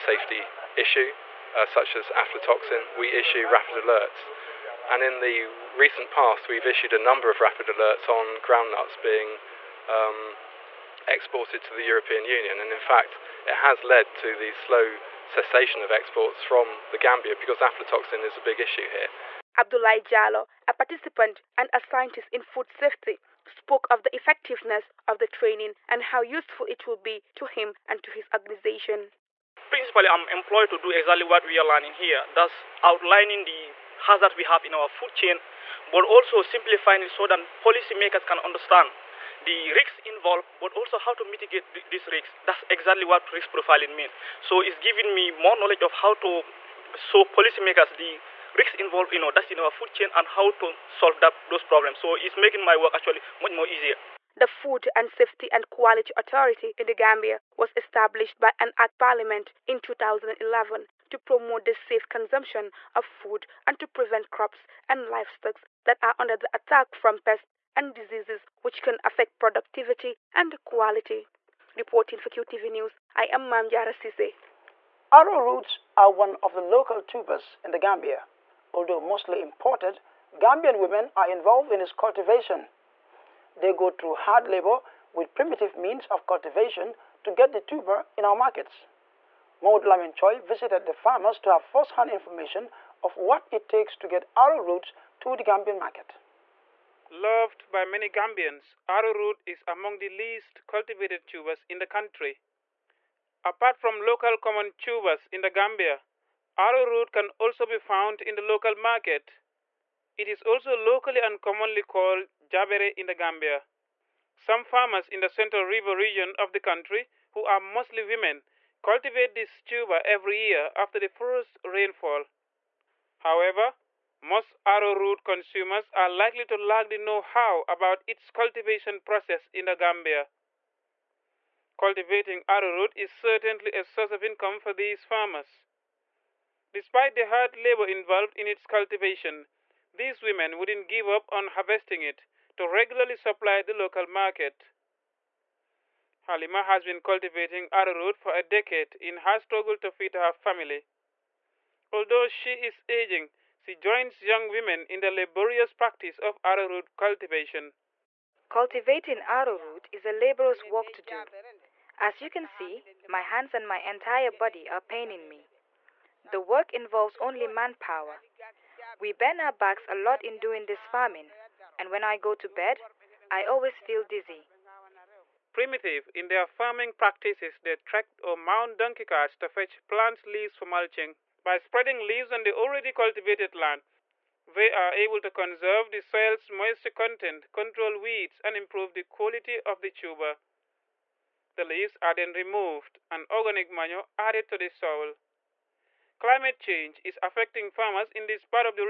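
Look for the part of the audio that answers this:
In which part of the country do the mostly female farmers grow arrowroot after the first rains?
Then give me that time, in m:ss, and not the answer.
1:55.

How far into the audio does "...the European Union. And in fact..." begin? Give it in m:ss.
0:11.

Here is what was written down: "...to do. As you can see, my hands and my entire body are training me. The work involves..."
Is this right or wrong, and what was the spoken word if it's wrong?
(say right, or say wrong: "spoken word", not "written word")
wrong: "paining", not "training".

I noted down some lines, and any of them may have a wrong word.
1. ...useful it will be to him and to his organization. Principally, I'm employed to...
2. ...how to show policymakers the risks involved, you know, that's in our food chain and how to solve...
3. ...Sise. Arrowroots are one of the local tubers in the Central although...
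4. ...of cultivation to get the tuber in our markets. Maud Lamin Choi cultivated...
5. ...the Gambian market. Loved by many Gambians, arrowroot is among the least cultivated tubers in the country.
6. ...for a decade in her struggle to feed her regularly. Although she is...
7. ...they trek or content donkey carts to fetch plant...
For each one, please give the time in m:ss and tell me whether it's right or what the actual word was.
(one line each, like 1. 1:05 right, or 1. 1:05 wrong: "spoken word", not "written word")
1. 0:26 right
2. 0:46 right
3. 1:13 wrong: "Gambia", not "Central"
4. 1:26 wrong: "visited", not "cultivated"
5. 1:35 right
6. 2:28 wrong: "family", not "regularly"
7. 2:57 wrong: "mount", not "content".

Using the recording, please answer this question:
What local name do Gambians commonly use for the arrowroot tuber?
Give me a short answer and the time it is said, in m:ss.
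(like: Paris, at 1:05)
Jabere, at 1:52.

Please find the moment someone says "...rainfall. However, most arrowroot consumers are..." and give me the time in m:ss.
2:01.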